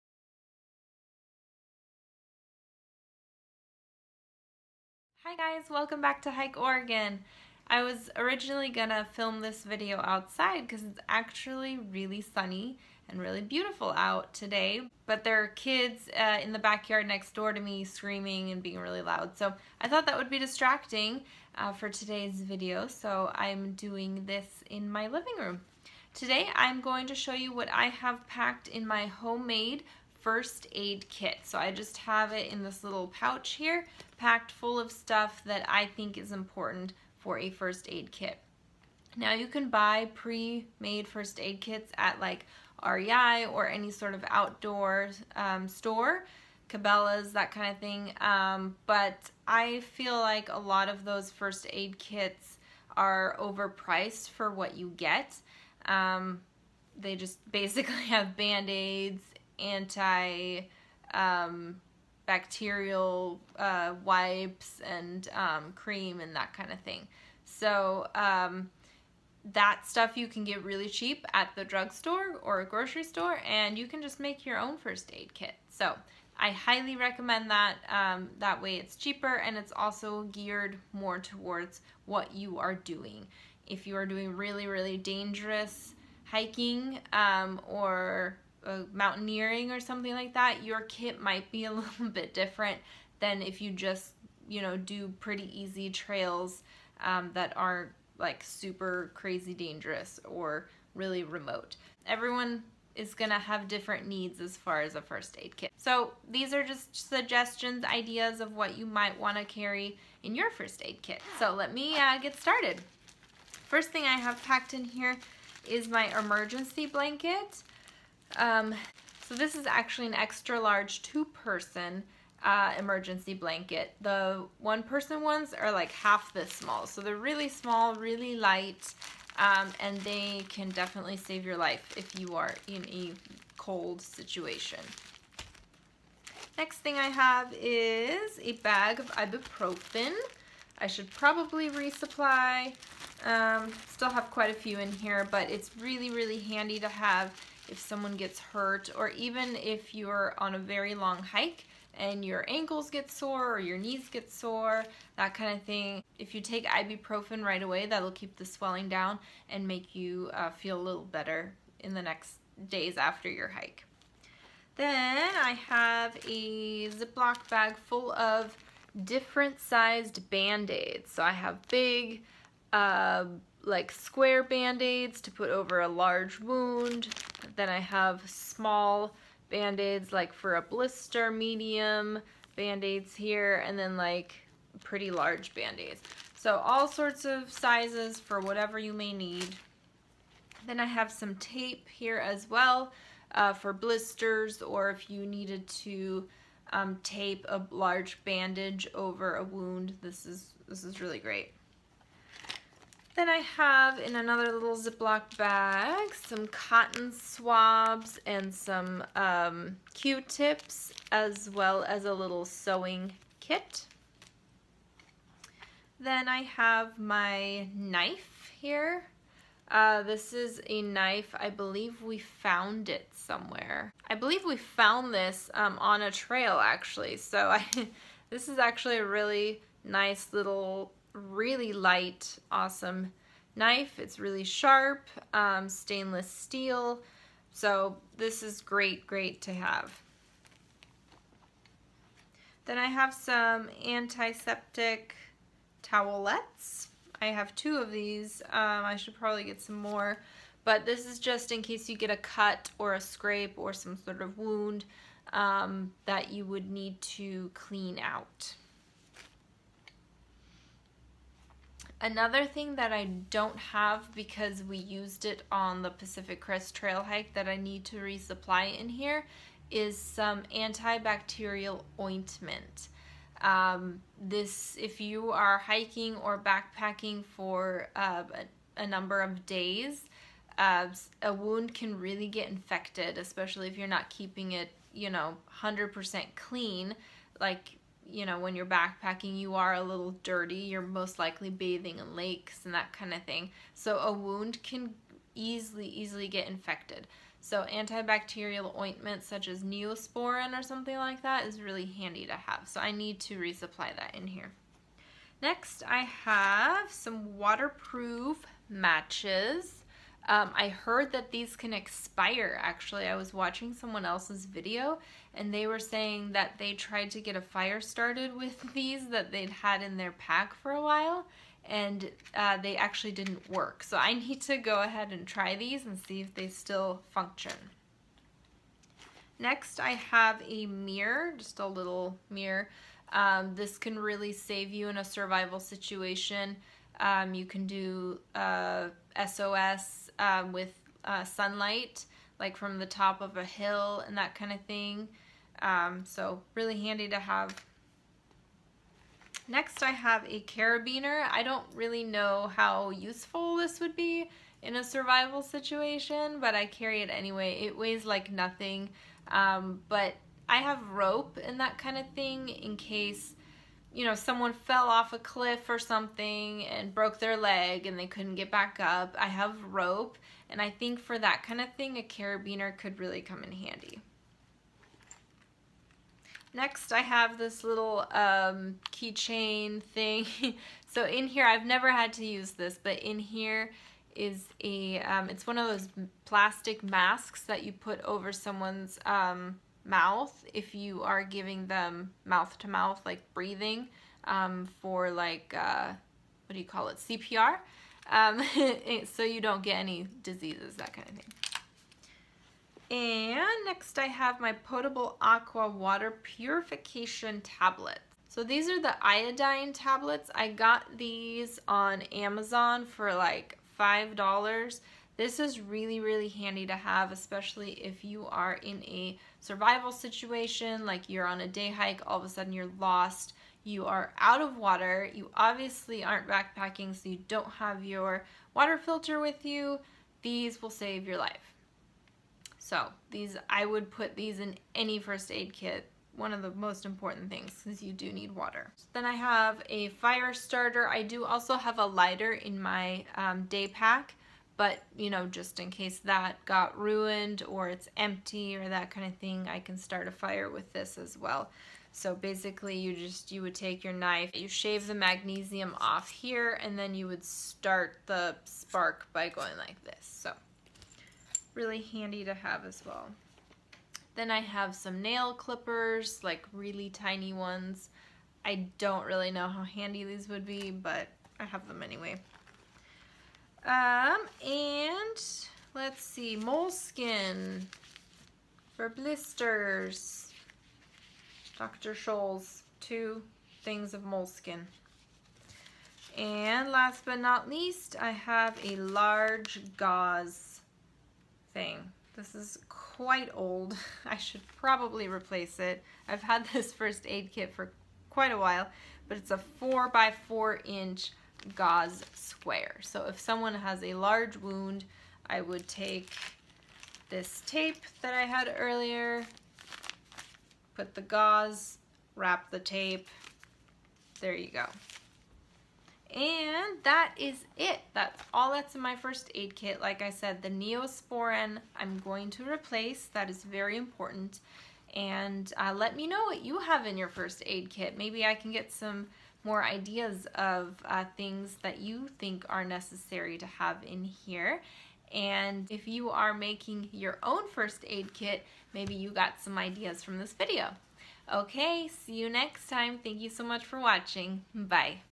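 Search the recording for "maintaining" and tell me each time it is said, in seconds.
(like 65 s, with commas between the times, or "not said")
not said.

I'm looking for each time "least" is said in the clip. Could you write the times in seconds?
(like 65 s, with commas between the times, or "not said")
487 s.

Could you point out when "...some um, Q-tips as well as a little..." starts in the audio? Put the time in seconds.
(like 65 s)
208 s.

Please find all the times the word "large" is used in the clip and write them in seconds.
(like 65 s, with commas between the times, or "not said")
120 s, 175 s, 185 s, 197 s, 488 s, 503 s.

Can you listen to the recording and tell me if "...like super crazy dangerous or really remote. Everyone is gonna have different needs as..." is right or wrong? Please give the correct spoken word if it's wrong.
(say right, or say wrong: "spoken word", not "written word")
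right.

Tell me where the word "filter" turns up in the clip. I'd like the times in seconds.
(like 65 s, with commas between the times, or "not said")
428 s.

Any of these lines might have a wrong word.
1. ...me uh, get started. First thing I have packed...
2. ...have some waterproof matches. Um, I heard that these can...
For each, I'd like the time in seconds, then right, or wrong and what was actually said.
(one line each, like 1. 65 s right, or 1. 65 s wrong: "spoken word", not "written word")
1. 111 s right
2. 306 s right.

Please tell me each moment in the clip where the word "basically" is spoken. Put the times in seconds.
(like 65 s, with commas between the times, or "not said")
57 s, 452 s.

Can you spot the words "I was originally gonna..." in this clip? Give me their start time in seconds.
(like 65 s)
7 s.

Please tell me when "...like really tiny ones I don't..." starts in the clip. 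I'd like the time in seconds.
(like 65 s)
466 s.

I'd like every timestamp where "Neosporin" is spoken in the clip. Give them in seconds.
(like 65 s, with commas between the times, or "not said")
299 s, 520 s.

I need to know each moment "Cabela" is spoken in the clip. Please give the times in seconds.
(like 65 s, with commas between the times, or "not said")
46 s.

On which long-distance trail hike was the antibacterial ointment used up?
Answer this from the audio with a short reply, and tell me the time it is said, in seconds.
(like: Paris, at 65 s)
Pacific Crest Trail, at 265 s.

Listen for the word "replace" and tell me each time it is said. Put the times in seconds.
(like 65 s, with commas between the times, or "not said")
495 s, 522 s.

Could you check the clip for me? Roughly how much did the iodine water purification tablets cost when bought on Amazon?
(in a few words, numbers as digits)
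$5.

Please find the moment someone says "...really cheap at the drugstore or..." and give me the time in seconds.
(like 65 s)
70 s.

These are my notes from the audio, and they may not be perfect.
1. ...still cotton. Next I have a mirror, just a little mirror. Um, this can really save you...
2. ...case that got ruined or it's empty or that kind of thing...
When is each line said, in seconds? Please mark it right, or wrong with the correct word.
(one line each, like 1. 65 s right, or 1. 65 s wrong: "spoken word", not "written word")
1. 326 s wrong: "function", not "cotton"
2. 445 s right.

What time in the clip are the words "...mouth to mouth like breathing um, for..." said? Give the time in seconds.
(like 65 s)
392 s.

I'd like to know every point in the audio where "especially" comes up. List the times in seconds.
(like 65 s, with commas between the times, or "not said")
283 s, 417 s.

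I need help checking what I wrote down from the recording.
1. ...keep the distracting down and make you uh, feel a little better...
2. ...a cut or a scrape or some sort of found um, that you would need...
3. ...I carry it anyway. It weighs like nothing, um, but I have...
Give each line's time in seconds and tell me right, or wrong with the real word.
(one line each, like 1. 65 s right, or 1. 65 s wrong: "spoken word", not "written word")
1. 158 s wrong: "swelling", not "distracting"
2. 252 s wrong: "wound", not "found"
3. 356 s right.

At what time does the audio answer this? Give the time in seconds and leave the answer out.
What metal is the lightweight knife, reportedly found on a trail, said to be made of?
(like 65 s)
235 s.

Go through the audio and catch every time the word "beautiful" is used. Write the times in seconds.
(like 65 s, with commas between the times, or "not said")
13 s.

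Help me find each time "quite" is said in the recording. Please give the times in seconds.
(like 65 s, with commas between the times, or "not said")
144 s, 492 s, 498 s.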